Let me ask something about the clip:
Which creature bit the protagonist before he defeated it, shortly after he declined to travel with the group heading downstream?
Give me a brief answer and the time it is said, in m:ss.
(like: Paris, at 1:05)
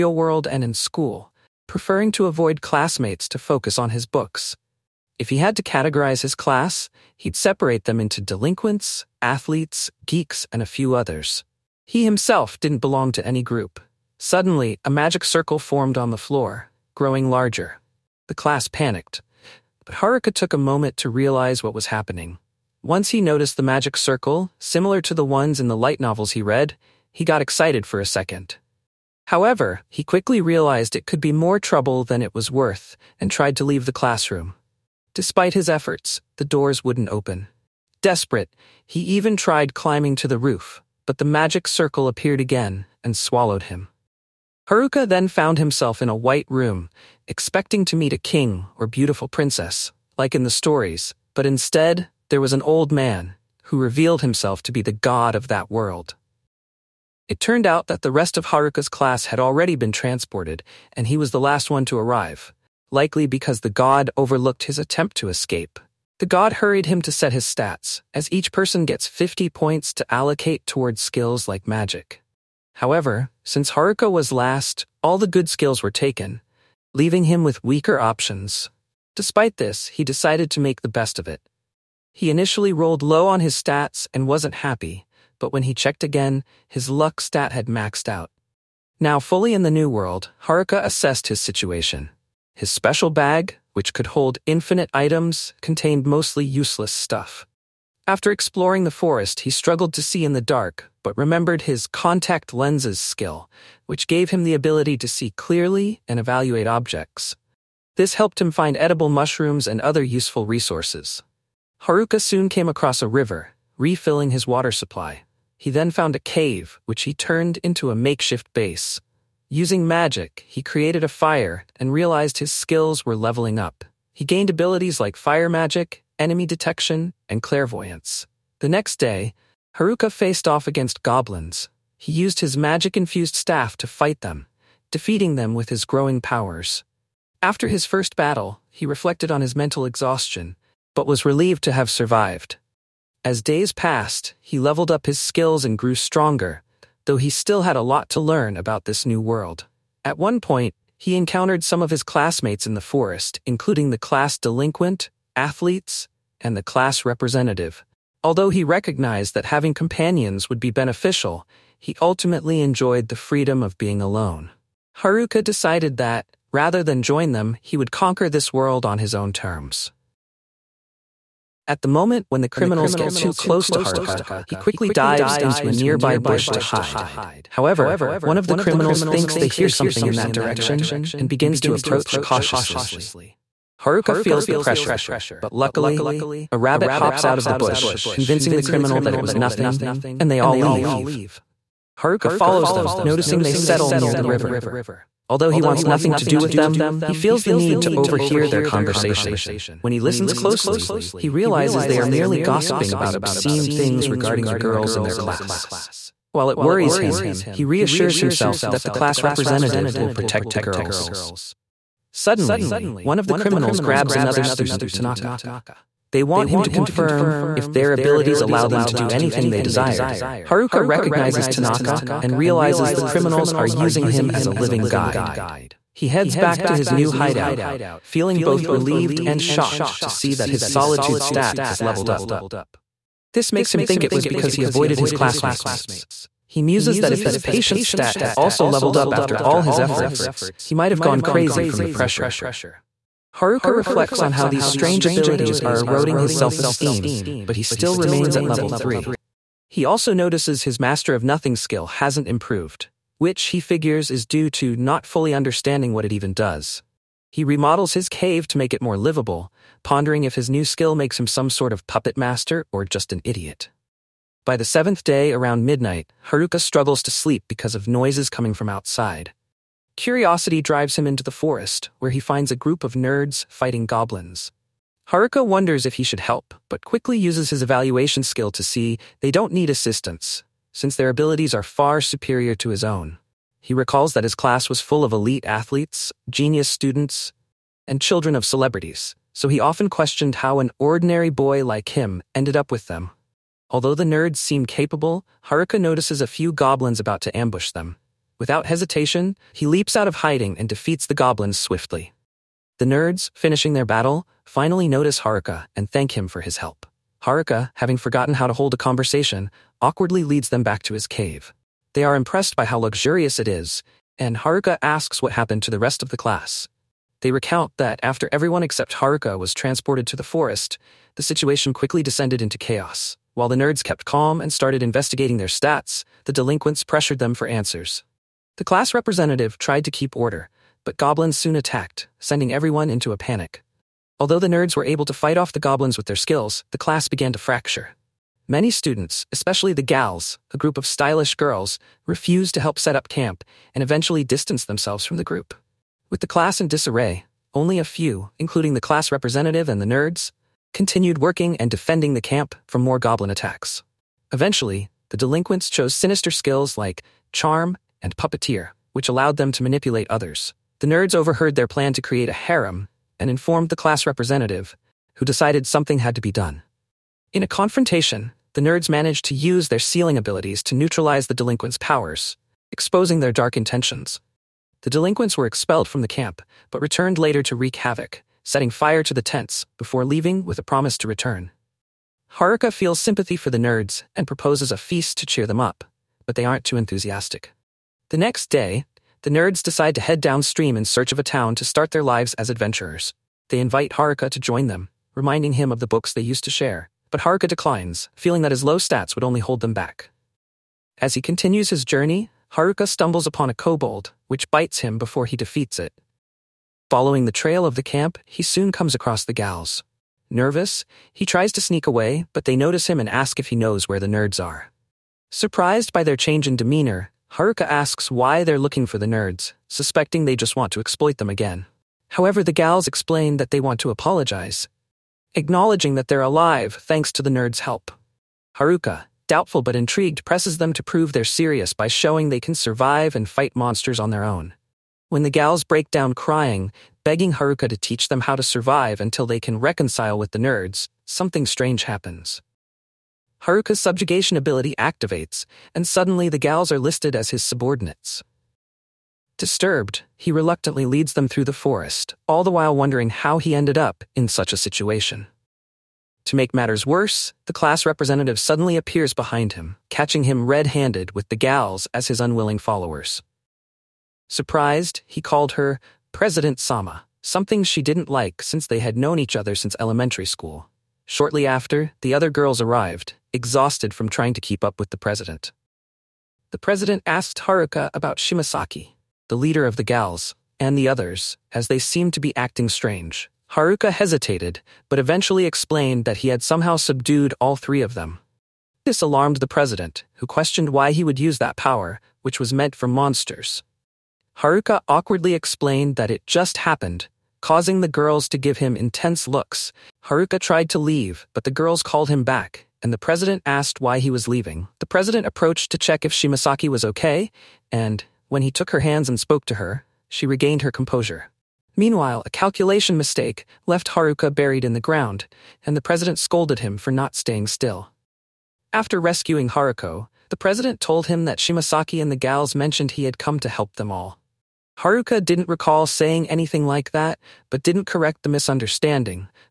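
kobold, at 6:43.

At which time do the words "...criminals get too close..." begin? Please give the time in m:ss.
2:52.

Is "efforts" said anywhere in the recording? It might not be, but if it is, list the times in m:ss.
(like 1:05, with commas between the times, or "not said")
0:35, 3:59.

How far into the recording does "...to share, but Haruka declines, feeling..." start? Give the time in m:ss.
6:36.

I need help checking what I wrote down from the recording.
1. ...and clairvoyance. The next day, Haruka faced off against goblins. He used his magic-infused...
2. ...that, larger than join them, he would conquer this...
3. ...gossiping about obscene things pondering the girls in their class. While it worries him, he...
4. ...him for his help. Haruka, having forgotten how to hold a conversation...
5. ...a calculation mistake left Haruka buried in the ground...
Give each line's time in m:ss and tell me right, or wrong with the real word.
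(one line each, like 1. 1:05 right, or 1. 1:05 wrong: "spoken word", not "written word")
1. 2:07 right
2. 2:45 wrong: "rather", not "larger"
3. 3:22 wrong: "regarding", not "pondering"
4. 5:06 right
5. 8:32 right.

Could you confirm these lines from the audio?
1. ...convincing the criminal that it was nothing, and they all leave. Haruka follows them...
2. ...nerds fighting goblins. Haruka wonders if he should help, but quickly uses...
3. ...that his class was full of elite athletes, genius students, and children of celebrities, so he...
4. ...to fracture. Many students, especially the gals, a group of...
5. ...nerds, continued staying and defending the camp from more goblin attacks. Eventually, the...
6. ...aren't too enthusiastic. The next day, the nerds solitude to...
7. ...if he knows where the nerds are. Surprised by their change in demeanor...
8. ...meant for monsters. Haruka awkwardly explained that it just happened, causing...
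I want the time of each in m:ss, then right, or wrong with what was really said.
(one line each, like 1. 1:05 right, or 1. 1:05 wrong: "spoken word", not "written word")
1. 3:08 right
2. 4:32 right
3. 4:44 right
4. 5:37 right
5. 5:49 wrong: "working", not "staying"
6. 6:26 wrong: "decide", not "solitude"
7. 6:53 right
8. 8:12 right.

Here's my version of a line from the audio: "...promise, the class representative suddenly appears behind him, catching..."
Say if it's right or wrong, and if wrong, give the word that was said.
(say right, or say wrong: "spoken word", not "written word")
wrong: "worse", not "promise".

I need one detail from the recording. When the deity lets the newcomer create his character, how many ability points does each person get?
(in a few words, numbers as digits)
50.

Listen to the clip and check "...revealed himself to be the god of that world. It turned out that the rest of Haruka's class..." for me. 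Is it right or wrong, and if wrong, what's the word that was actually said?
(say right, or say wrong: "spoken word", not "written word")
right.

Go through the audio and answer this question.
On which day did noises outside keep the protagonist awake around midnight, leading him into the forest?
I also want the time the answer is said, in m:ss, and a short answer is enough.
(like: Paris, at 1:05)
seventh day, at 4:24.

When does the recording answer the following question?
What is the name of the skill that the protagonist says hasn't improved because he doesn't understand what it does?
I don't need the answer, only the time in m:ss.
4:10.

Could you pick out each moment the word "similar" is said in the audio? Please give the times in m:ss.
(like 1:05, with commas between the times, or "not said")
0:24.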